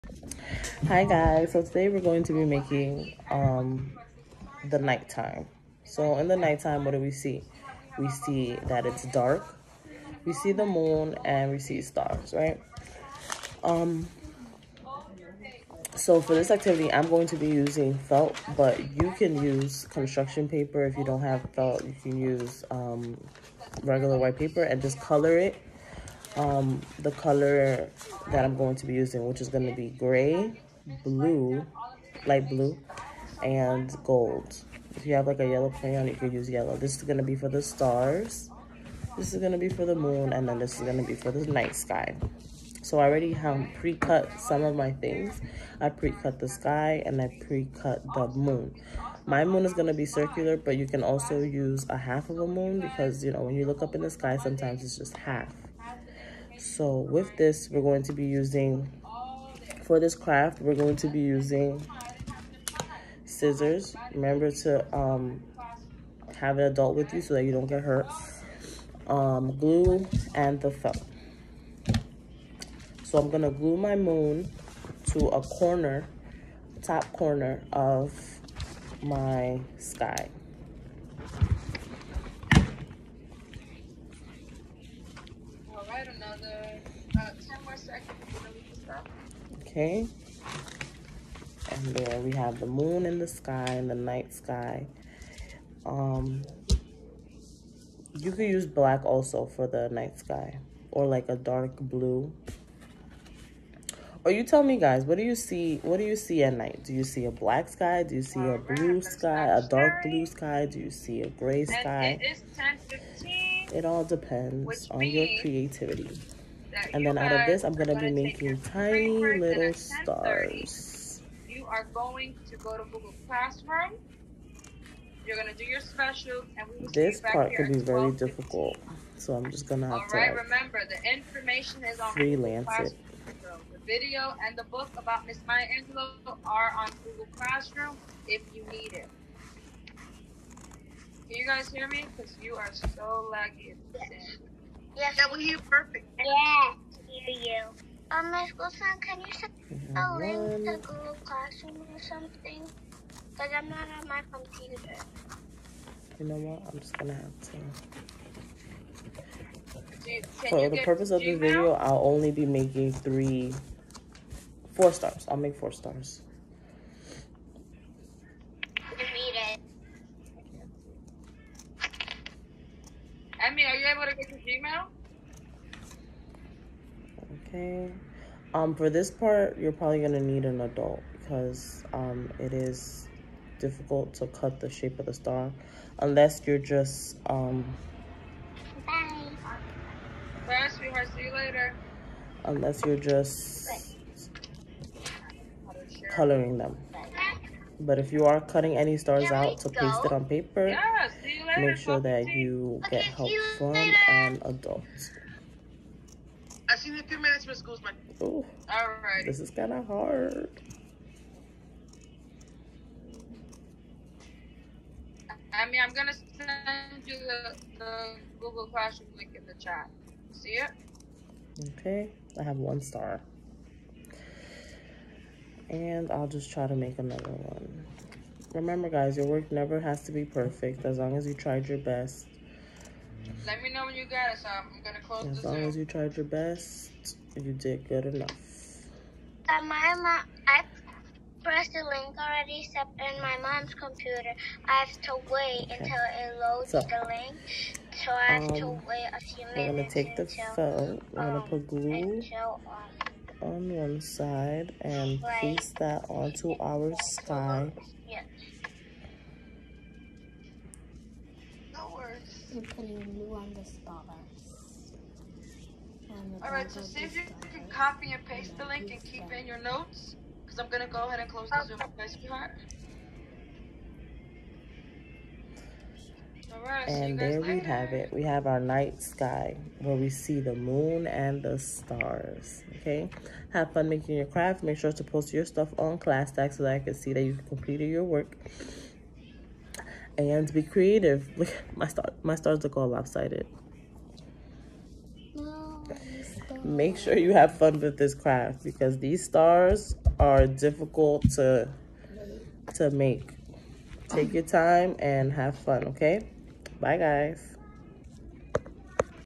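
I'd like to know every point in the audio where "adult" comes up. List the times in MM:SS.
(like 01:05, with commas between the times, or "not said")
01:06, 03:00, 03:24.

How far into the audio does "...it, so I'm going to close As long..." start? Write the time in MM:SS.
03:54.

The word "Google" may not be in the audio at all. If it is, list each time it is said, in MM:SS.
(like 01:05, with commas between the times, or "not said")
02:02, 02:17, 02:30, 03:38.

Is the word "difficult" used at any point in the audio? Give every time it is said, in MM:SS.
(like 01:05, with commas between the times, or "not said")
02:08, 03:03, 05:00.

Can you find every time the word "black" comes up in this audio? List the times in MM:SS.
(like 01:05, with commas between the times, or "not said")
01:38, 01:47.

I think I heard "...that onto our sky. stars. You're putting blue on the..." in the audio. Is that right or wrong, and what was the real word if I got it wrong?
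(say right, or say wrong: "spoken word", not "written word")
right.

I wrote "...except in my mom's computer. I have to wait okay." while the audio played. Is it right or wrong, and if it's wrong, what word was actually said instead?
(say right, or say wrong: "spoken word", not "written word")
right.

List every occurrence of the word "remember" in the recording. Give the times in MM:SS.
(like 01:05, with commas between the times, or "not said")
01:04, 02:10, 03:48.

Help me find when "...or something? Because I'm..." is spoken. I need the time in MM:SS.
02:31.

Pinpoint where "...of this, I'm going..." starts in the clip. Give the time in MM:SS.
01:57.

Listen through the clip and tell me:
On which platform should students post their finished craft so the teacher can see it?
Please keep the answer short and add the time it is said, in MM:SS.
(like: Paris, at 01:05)
ClassDojo, at 04:45.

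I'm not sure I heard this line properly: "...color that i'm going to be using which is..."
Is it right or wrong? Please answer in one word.
right.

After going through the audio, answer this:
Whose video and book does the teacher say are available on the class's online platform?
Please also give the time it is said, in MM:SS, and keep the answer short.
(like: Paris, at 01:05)
Maya Angelou, at 02:15.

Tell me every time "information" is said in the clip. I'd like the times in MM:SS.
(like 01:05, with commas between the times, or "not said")
02:11.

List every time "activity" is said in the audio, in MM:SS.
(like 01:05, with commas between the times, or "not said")
00:16.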